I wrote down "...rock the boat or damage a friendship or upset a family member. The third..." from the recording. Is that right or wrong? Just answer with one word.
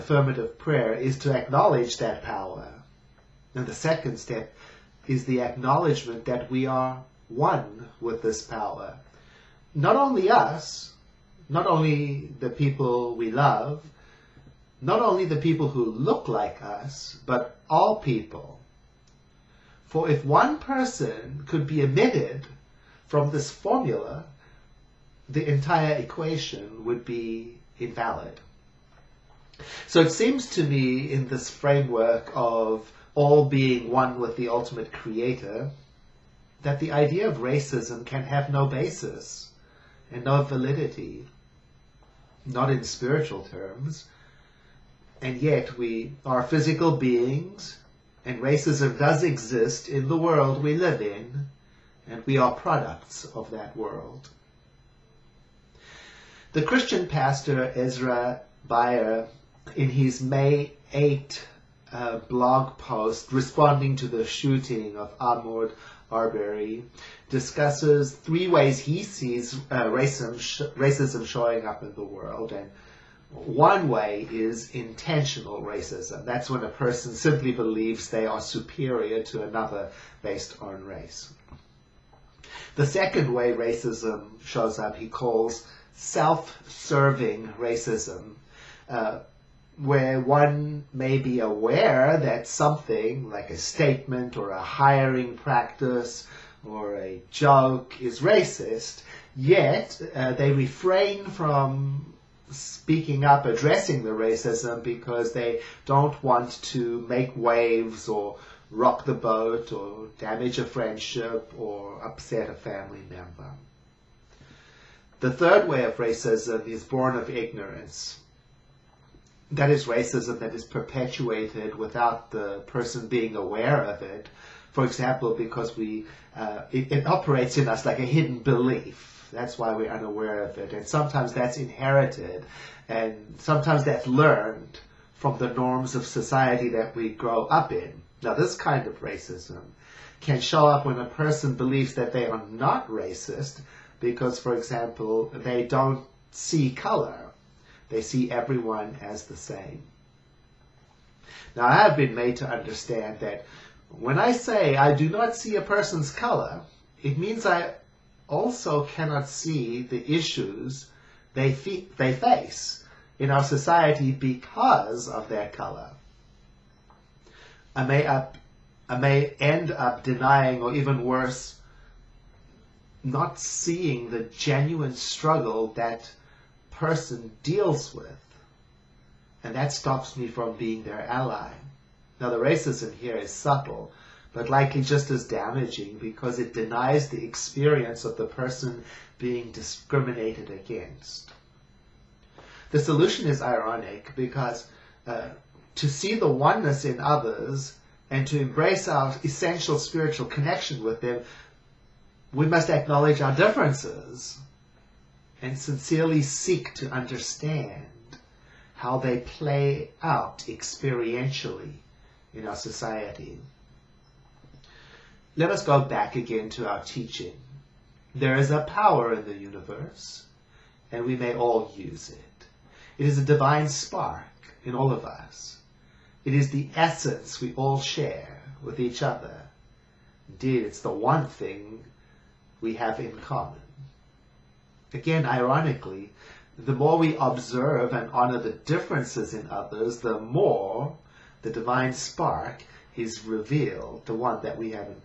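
right.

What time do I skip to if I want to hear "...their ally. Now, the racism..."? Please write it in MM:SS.
03:00.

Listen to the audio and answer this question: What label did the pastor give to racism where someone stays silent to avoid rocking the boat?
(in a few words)
self serving racism.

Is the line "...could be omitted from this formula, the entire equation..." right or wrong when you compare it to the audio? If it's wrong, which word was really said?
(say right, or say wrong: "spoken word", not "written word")
right.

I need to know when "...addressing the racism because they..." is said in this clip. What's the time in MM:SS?
01:43.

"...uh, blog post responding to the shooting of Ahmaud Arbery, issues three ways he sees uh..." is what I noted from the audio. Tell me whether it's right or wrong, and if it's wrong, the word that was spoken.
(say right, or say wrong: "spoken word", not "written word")
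wrong: "discusses", not "issues".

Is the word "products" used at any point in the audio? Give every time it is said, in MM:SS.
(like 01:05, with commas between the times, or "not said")
00:52.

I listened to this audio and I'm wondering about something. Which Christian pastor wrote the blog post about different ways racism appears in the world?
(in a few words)
Ezra Bayer.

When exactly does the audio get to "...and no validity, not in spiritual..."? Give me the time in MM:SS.
00:40.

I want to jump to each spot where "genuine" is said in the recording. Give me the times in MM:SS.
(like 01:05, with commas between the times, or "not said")
02:54.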